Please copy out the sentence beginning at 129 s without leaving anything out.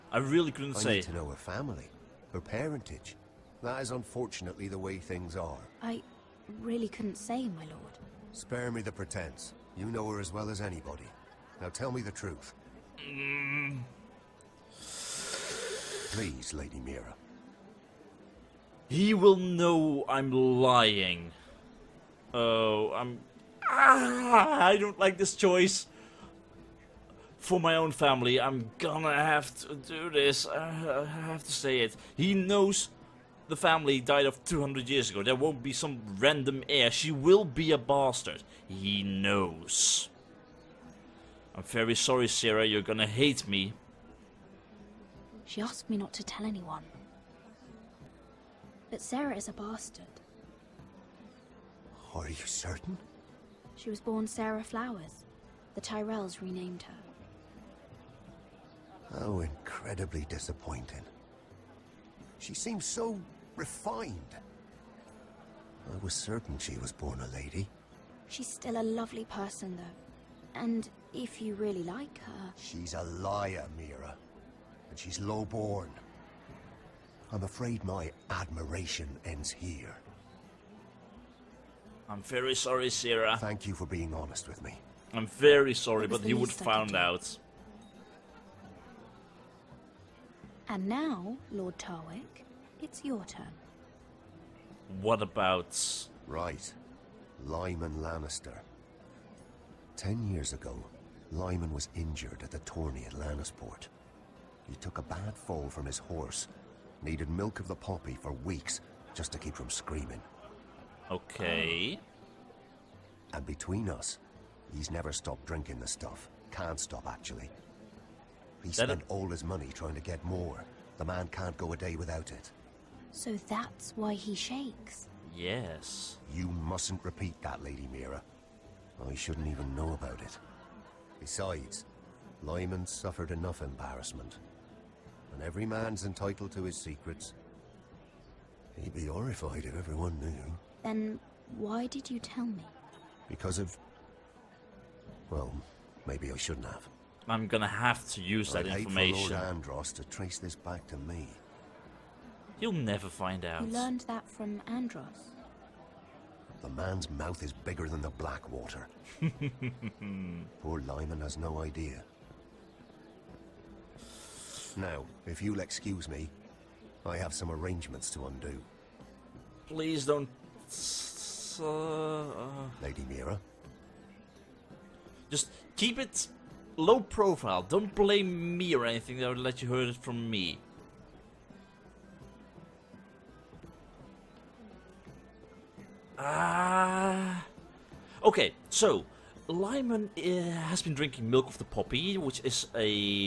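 I shouldn't even know about it.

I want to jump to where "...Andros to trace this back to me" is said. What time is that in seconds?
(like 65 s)
149 s.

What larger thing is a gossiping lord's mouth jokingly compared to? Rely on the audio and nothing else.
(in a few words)
The Blackwater.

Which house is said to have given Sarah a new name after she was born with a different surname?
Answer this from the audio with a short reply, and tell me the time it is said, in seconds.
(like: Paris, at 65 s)
The Tyrells, at 55 s.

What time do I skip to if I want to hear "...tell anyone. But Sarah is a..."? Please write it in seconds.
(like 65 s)
46 s.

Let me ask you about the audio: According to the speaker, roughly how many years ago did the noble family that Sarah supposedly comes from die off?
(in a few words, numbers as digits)
200.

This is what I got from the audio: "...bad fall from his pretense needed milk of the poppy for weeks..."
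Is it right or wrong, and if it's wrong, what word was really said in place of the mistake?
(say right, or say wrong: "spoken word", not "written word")
wrong: "horse", not "pretense".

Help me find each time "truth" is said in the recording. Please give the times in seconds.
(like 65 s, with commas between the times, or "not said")
12 s.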